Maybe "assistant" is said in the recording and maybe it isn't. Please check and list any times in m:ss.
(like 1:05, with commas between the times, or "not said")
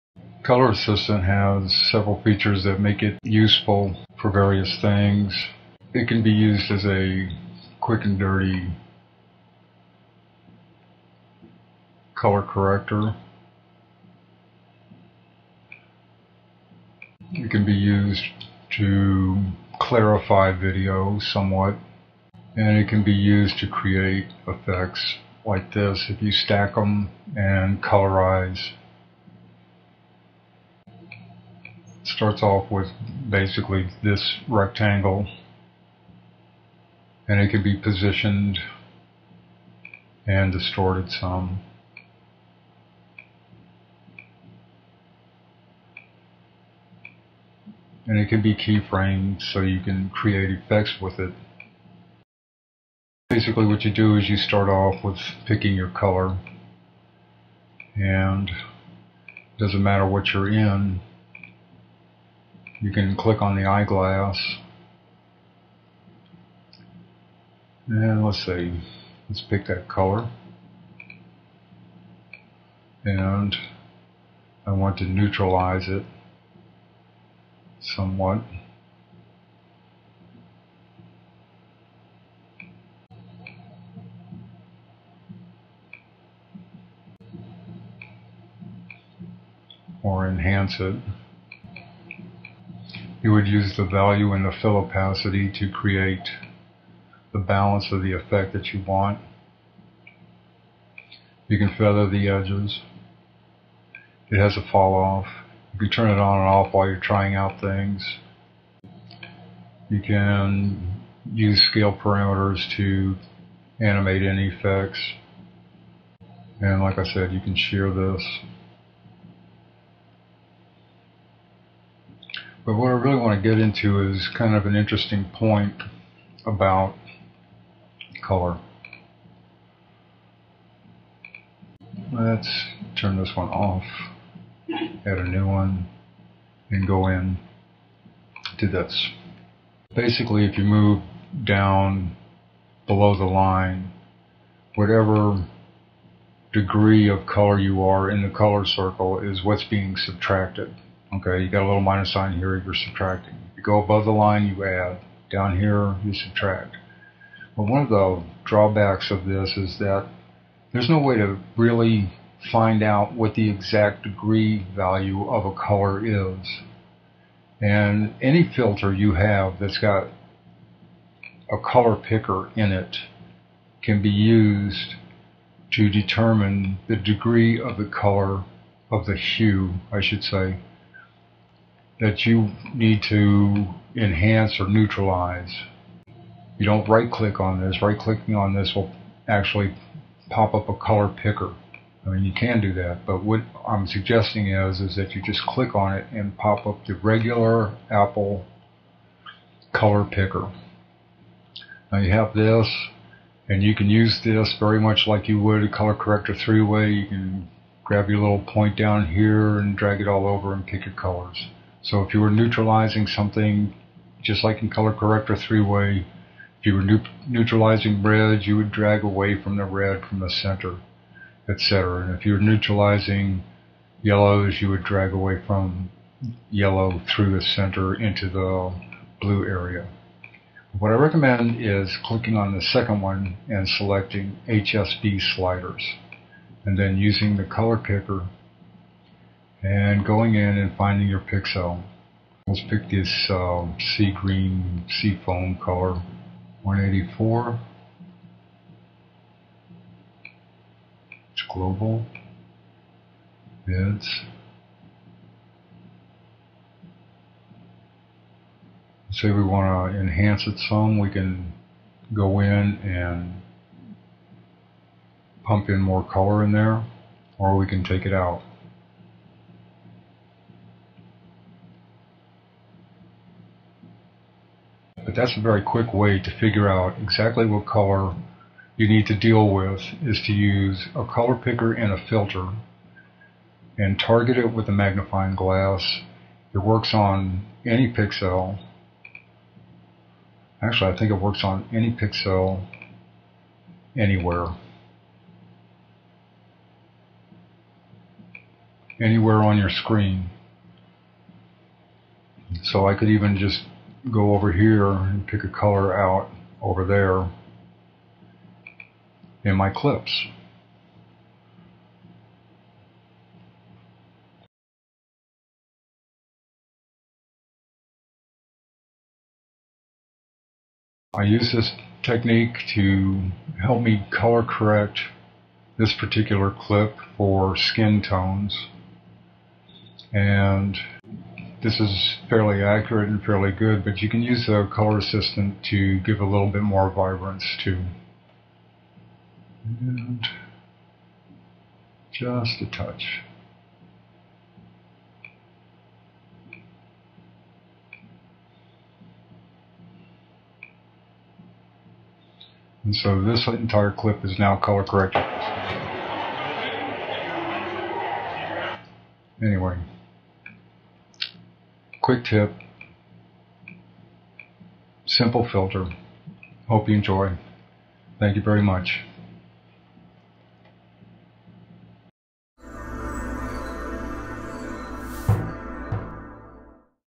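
0:00, 5:34.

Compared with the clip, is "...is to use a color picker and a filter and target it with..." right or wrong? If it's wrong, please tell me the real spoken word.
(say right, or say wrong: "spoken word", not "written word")
right.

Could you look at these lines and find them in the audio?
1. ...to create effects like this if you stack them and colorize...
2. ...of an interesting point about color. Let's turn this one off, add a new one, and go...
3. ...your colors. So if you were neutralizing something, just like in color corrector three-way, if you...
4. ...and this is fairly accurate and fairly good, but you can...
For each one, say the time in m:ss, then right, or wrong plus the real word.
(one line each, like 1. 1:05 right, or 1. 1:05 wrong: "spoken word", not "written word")
1. 0:23 right
2. 2:04 right
3. 3:30 right
4. 5:30 right.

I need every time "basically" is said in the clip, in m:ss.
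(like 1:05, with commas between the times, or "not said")
0:33, 0:53, 2:19.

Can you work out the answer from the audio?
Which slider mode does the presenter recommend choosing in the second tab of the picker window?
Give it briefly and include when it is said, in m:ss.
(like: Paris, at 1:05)
HSB sliders, at 3:54.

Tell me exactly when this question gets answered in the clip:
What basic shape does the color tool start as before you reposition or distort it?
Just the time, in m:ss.
0:34.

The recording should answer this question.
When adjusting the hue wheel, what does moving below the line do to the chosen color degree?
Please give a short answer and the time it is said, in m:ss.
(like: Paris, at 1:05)
subtracting, at 2:32.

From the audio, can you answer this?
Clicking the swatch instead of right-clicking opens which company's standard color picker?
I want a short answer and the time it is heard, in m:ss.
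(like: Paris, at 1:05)
Apple, at 3:17.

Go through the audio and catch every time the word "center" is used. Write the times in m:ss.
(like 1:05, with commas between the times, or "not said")
3:40, 3:47.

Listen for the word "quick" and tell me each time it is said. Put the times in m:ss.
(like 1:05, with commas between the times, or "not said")
0:07, 4:35, 6:02.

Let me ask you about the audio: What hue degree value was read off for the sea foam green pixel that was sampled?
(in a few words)
184.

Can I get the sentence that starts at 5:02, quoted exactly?
So I could even just go over here and pick a color out over there in my clips.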